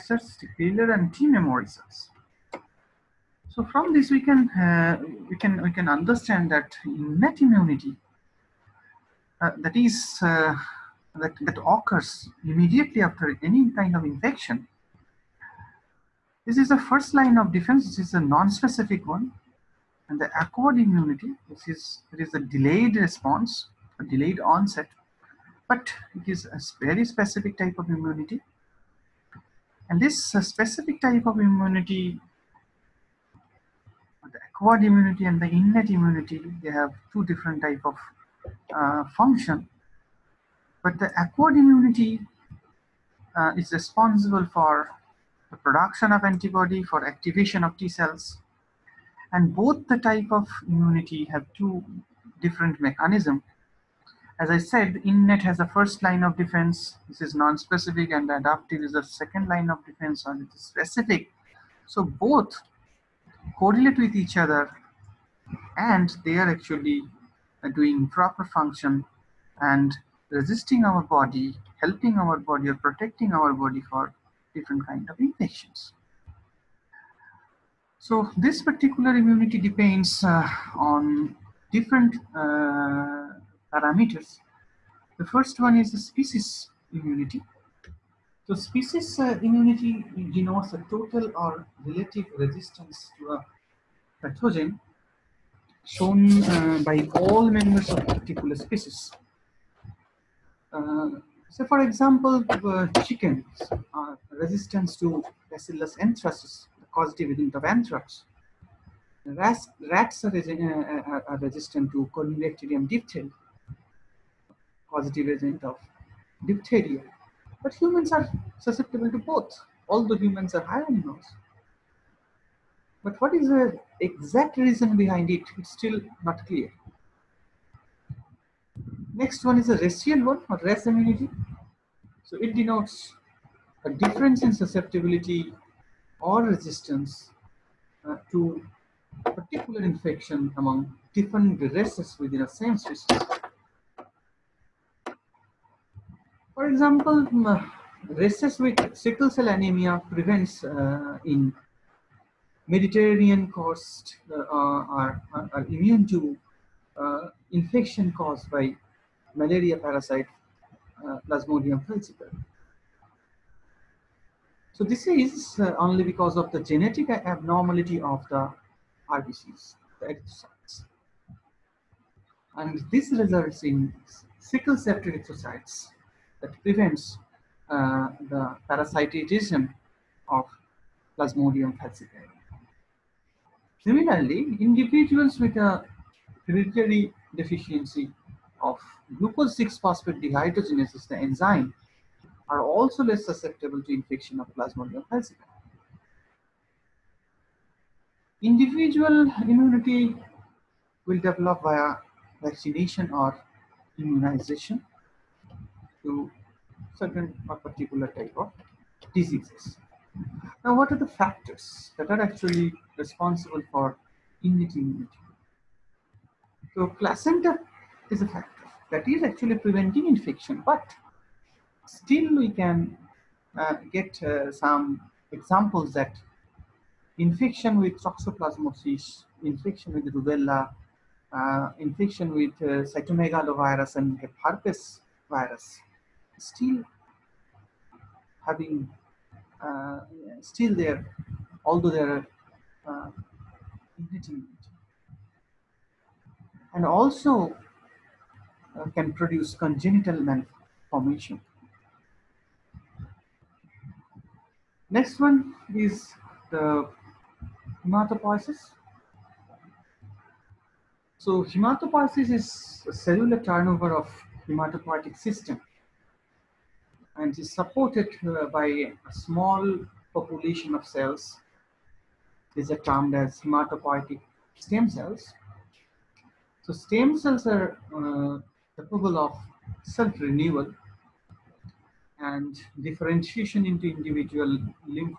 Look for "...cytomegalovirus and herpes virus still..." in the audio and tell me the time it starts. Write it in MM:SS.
03:52.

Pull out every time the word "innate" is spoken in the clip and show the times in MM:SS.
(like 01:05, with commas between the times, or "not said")
00:06, 00:35, 00:55, 03:34.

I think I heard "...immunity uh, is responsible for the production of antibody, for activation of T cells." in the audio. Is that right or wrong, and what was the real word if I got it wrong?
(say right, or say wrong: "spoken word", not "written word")
right.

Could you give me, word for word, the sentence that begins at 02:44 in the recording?
So this is uh, only because of the genetic abnormality of the RBCs, the erythrocytes.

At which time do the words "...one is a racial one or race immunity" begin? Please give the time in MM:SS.
02:09.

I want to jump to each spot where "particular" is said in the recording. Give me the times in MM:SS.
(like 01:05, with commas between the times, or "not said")
01:18, 01:38, 02:19, 03:27.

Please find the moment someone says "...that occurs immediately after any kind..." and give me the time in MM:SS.
00:11.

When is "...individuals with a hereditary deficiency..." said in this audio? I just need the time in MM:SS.
03:04.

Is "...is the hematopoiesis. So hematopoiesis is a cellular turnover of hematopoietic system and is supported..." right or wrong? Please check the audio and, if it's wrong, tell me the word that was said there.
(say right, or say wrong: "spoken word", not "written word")
right.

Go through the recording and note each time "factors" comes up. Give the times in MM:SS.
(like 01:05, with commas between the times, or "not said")
03:31, 03:38.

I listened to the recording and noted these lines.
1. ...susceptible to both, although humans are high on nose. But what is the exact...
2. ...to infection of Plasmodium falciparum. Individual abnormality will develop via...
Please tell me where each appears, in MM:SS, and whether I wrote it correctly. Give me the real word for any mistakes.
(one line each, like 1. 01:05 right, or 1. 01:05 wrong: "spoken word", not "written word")
1. 01:58 right
2. 03:13 wrong: "immunity", not "abnormality".